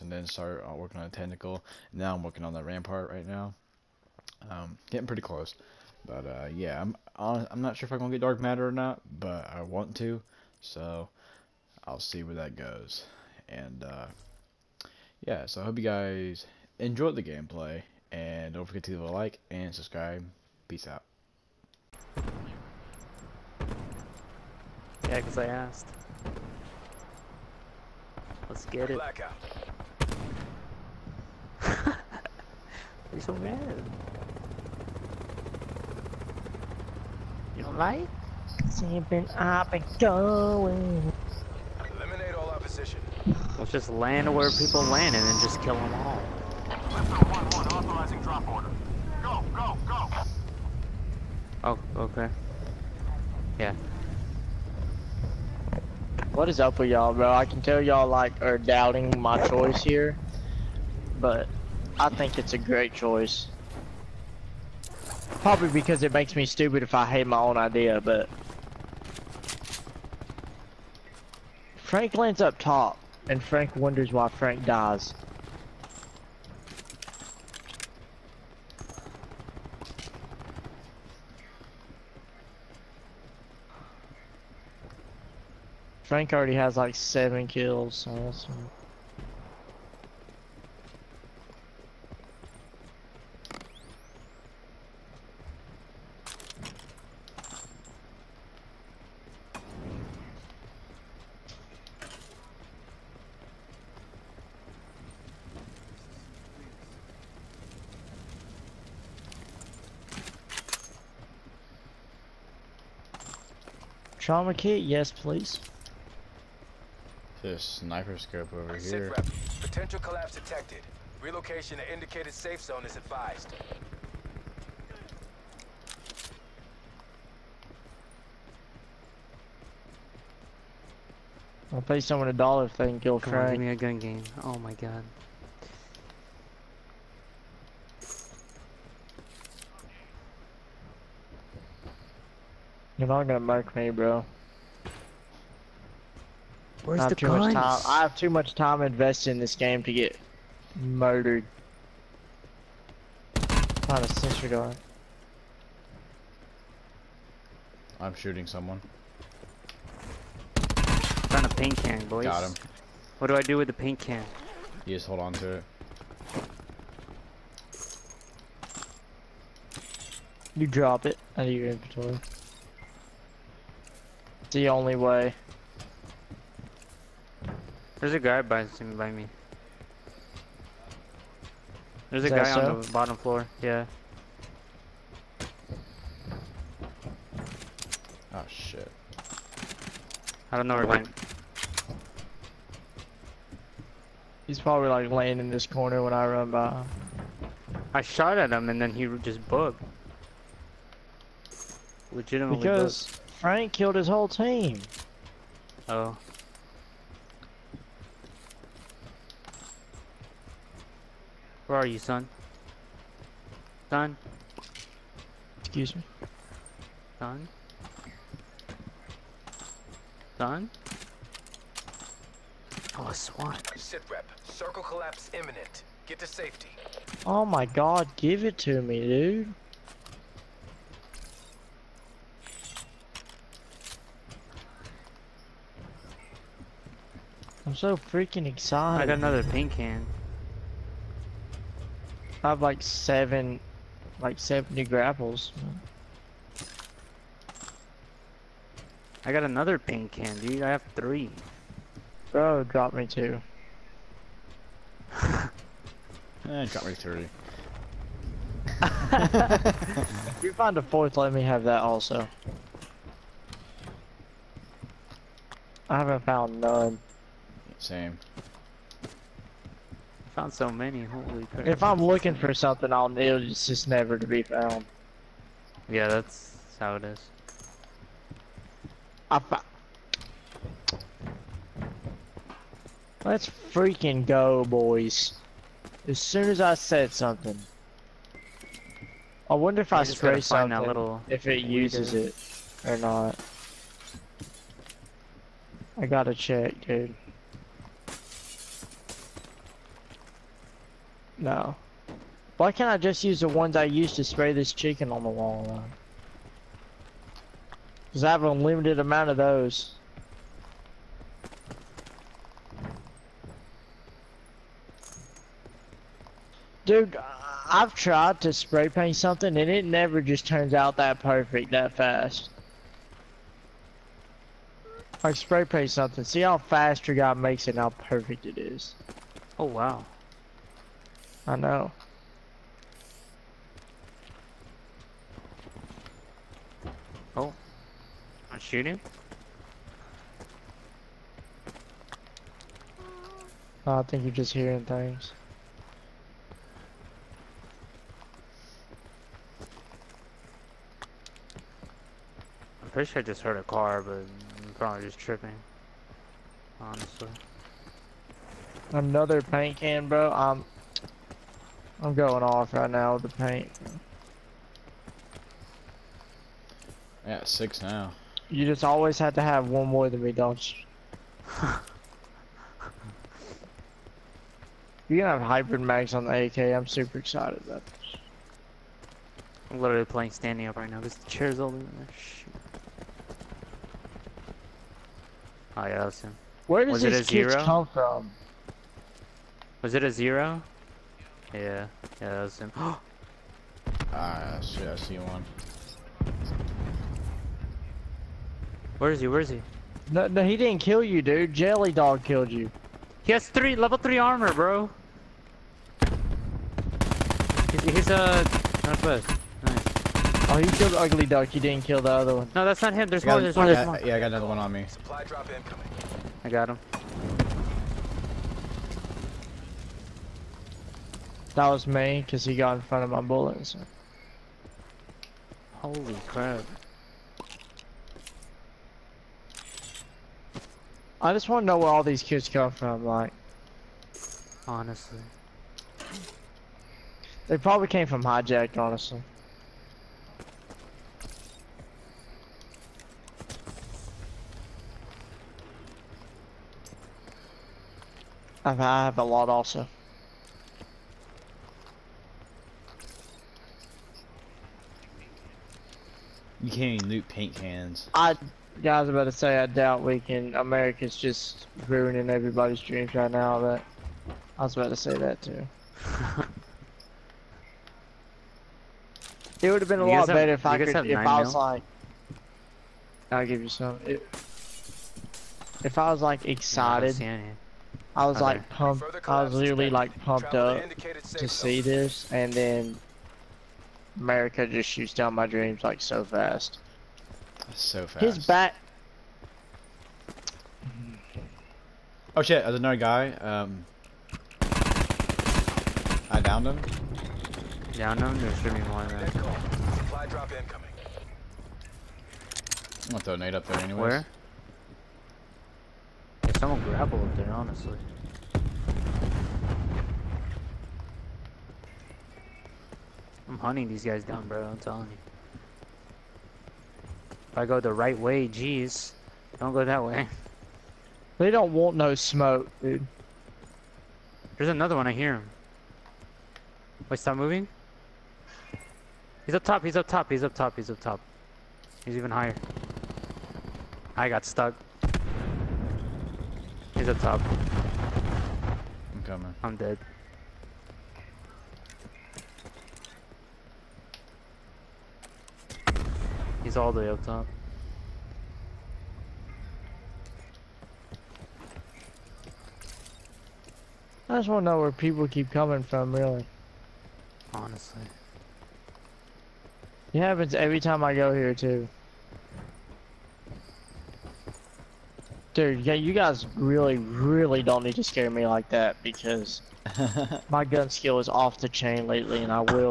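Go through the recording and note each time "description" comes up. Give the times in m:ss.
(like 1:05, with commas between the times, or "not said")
not said.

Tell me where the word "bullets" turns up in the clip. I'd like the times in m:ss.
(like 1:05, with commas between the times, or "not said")
7:03.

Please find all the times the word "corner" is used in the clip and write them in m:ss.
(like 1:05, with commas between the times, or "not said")
3:15.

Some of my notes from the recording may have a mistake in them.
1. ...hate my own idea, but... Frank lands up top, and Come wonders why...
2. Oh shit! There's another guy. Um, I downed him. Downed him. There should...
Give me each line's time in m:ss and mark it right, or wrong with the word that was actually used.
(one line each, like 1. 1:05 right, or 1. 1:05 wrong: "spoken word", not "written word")
1. 1:07 wrong: "Frank", not "Come"
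2. 8:12 right.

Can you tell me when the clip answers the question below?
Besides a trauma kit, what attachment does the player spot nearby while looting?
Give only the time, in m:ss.
1:57.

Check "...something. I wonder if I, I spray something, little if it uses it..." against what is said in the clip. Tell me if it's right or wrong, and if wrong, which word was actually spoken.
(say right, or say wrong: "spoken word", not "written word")
right.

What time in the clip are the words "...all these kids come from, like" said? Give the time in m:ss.
7:11.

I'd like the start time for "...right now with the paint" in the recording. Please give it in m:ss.
6:02.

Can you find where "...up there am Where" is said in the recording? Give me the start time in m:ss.
8:23.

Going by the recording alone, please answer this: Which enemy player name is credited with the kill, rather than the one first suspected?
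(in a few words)
Jelly Dog.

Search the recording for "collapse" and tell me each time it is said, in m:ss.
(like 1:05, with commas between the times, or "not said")
1:59, 3:44.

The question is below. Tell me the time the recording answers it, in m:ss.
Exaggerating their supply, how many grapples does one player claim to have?
4:04.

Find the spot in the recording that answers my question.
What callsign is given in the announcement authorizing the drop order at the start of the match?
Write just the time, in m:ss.
0:46.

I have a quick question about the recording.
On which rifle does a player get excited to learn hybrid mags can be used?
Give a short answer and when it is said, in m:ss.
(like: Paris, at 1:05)
AK, at 6:16.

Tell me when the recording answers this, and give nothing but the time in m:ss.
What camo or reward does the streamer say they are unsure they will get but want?
0:08.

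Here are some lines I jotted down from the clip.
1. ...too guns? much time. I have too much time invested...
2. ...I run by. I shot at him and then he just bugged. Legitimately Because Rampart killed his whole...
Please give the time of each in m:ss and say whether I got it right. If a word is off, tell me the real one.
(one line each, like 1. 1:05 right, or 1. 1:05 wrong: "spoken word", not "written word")
1. 2:27 right
2. 3:16 wrong: "Frank", not "Rampart".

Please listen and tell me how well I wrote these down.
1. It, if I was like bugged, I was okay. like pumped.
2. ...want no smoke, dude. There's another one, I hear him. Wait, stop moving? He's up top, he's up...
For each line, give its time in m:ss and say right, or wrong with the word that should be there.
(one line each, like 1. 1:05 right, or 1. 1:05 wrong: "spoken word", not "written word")
1. 7:54 wrong: "excited", not "bugged"
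2. 8:41 right.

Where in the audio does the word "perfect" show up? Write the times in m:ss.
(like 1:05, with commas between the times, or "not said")
5:21, 5:27.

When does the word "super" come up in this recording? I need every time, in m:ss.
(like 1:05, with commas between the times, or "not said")
6:16.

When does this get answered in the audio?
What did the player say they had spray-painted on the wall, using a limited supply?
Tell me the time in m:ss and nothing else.
5:04.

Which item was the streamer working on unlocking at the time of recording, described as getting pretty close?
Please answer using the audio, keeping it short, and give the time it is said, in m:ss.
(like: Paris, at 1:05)
Rampart, at 0:02.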